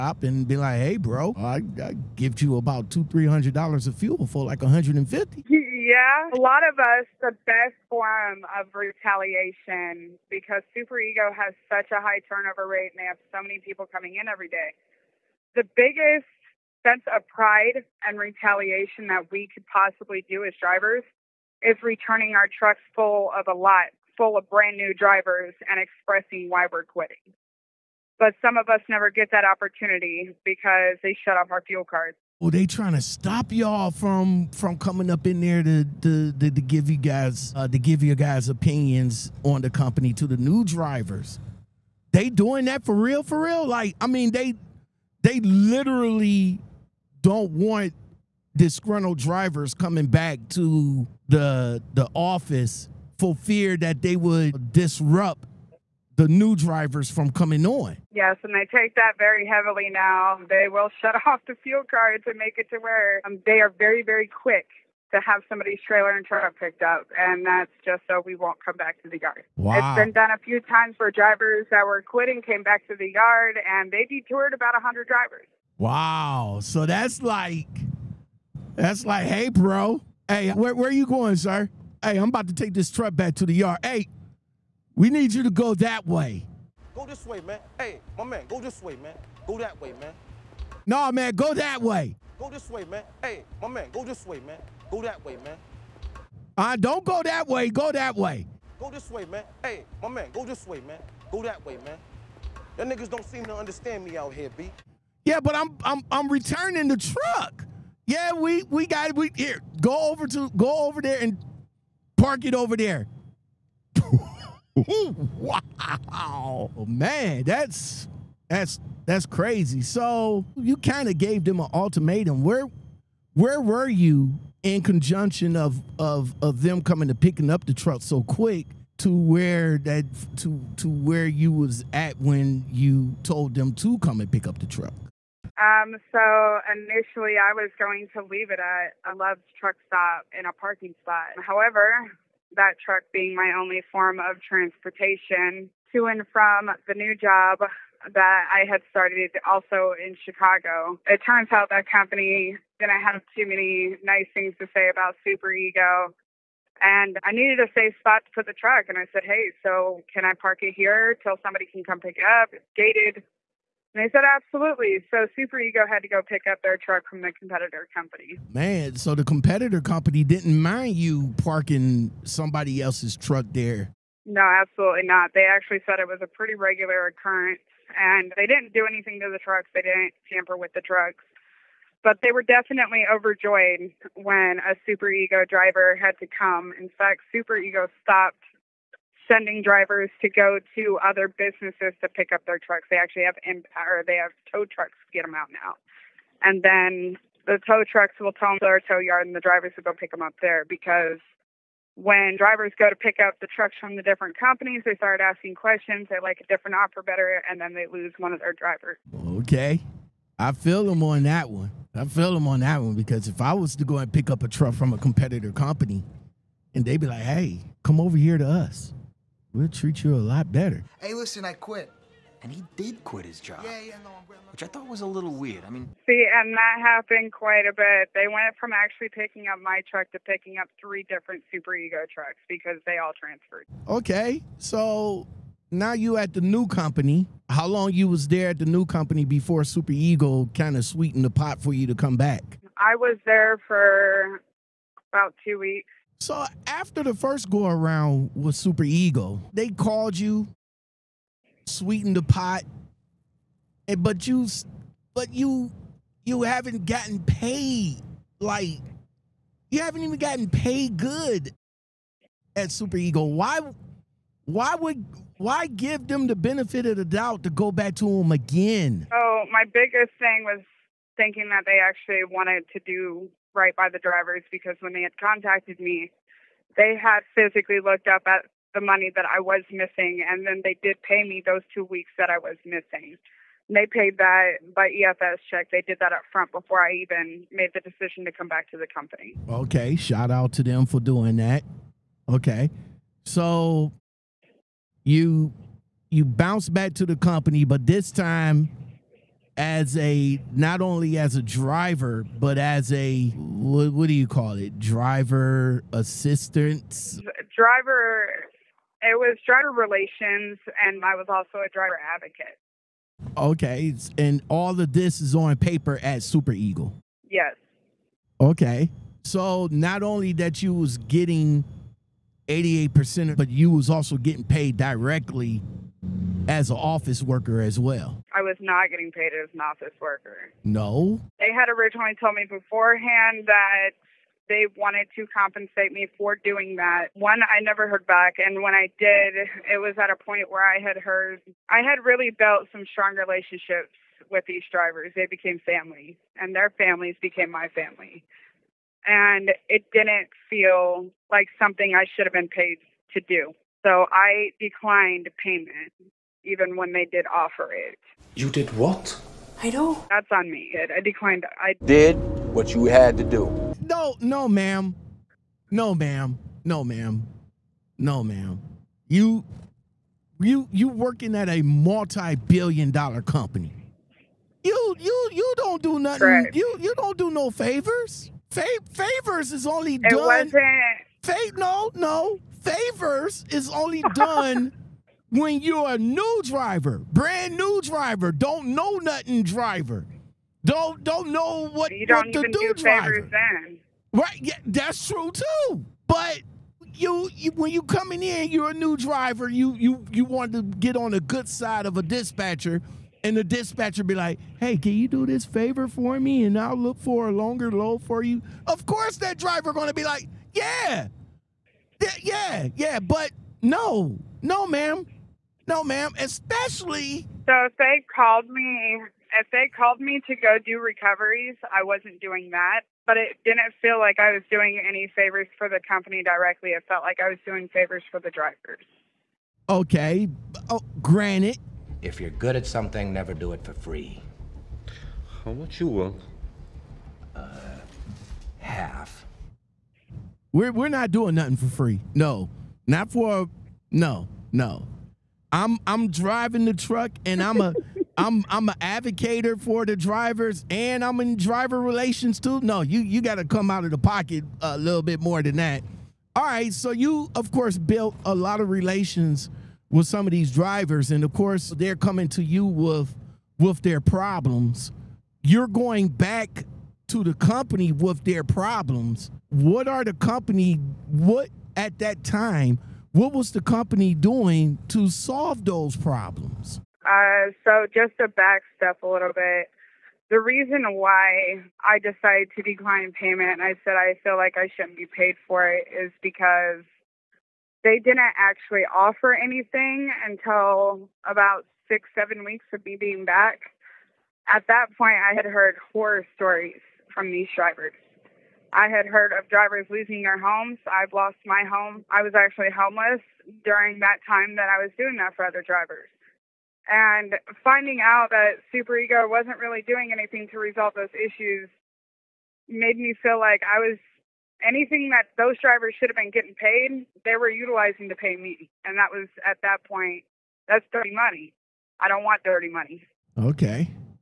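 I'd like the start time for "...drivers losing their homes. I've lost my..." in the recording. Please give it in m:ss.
8:19.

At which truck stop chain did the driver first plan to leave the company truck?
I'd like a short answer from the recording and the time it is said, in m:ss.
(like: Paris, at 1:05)
Love's, at 2:19.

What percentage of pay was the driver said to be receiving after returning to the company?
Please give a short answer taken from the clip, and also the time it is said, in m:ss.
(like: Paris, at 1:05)
88%, at 5:22.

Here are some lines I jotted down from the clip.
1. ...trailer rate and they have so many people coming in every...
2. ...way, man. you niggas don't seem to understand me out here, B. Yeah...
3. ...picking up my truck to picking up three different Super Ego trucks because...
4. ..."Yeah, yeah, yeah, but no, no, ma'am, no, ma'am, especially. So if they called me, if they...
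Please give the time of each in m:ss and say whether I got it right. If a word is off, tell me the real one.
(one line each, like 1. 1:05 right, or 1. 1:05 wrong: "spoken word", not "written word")
1. 0:12 wrong: "turnover", not "trailer"
2. 1:41 right
3. 3:49 right
4. 6:50 right.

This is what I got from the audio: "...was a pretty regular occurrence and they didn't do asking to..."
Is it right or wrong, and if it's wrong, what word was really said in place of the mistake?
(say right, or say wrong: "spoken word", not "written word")
wrong: "anything", not "asking".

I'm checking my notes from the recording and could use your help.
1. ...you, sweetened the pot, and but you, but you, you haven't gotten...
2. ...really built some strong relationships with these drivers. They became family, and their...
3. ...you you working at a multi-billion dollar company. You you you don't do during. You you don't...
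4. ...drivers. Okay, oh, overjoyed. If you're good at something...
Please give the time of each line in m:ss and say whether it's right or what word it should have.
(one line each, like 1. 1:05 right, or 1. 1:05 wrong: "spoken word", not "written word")
1. 4:10 right
2. 5:42 right
3. 6:10 wrong: "nothing", not "during"
4. 7:08 wrong: "granted", not "overjoyed".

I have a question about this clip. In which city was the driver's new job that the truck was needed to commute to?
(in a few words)
Chicago.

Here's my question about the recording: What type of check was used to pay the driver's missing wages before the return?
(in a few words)
EFS check.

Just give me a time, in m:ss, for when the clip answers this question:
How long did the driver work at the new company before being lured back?
4:05.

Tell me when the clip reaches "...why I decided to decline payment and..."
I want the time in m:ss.
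8:00.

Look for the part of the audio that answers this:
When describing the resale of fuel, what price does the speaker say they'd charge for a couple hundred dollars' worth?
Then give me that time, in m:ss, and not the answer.
0:04.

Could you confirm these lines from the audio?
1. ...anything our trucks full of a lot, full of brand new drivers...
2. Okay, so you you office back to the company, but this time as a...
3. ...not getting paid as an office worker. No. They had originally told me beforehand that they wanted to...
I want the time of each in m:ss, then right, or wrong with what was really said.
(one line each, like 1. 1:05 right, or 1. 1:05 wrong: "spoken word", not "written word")
1. 0:21 wrong: "returning", not "anything"
2. 4:52 wrong: "bounce", not "office"
3. 5:28 right.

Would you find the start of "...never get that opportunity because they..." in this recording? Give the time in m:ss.
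0:28.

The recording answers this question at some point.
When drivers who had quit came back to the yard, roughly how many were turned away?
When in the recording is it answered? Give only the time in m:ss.
1:14.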